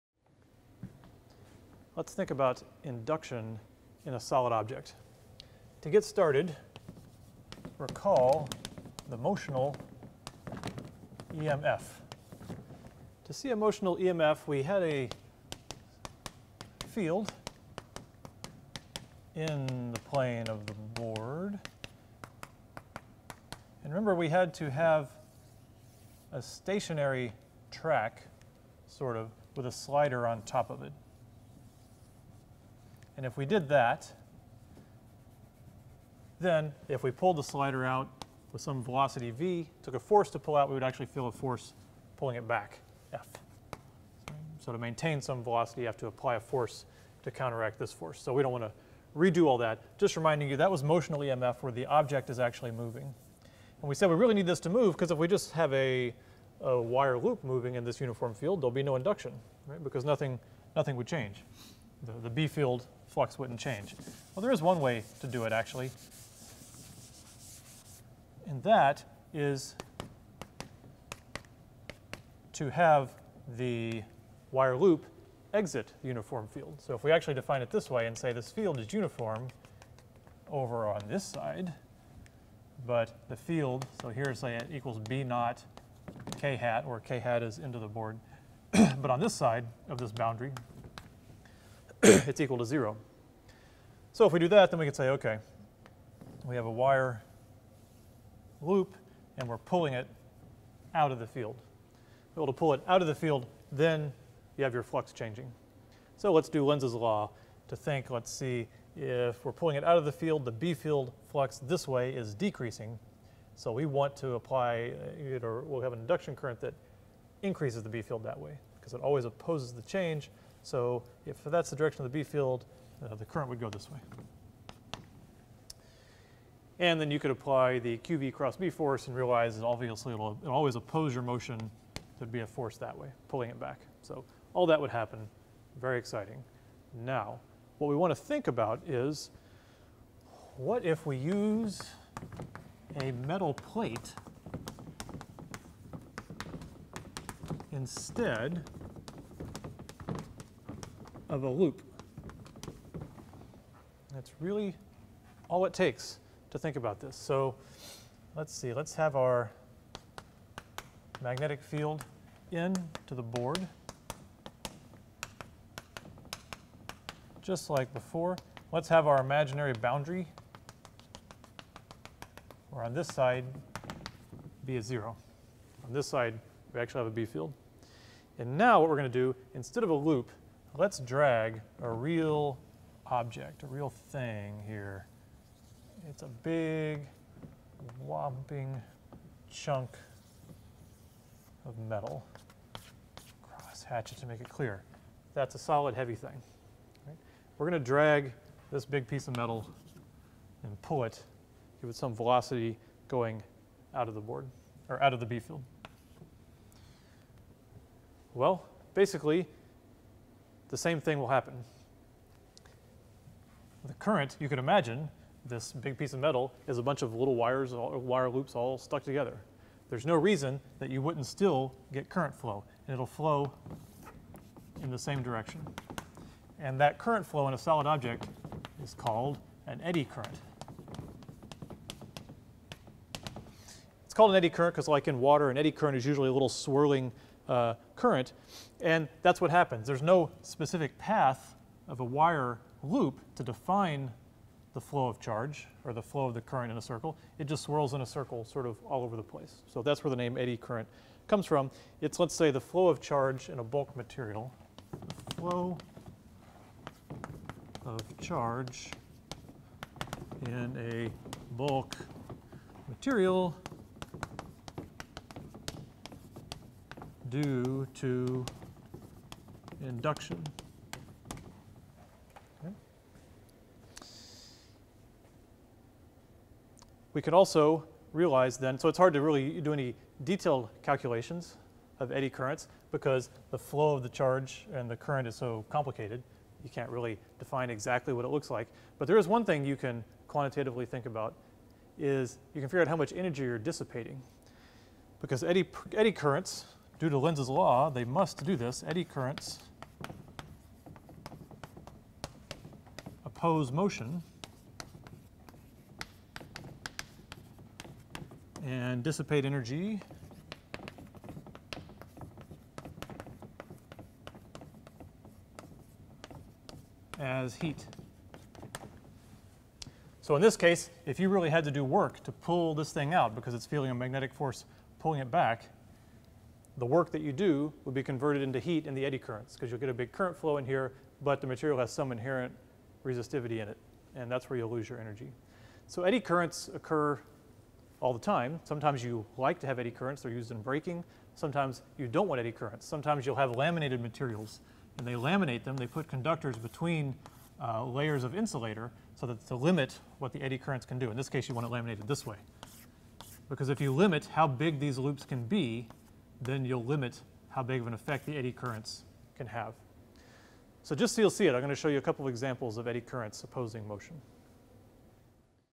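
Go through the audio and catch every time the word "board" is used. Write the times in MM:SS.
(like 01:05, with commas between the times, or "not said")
00:20, 01:27, 02:43, 03:24.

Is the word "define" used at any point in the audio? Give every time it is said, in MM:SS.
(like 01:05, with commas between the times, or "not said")
01:17, 04:03, 04:47.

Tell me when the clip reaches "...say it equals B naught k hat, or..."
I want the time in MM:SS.
01:24.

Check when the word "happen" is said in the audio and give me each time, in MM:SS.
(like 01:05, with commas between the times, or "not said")
02:14, 03:31, 03:59.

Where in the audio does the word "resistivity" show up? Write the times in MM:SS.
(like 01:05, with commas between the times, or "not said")
05:33.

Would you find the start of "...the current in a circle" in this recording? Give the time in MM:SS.
04:06.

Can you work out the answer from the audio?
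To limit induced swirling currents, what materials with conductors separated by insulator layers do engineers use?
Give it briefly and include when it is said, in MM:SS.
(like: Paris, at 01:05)
laminated materials, at 05:43.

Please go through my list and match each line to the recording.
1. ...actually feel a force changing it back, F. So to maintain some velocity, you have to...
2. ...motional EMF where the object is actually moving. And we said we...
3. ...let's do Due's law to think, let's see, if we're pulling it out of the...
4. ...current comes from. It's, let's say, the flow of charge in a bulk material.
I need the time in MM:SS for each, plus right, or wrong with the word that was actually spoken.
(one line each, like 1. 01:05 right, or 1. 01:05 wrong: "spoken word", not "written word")
1. 00:40 wrong: "pulling", not "changing"
2. 00:50 right
3. 01:46 wrong: "Lenz", not "Due"
4. 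04:10 right.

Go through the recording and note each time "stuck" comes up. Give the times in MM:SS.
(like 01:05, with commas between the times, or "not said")
03:38.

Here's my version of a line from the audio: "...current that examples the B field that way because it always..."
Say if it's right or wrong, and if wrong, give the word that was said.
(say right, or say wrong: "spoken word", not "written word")
wrong: "increases", not "examples".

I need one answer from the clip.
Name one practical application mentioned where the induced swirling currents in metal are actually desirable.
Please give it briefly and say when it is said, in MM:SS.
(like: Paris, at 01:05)
braking, at 05:40.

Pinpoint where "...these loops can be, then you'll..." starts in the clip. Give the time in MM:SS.
05:54.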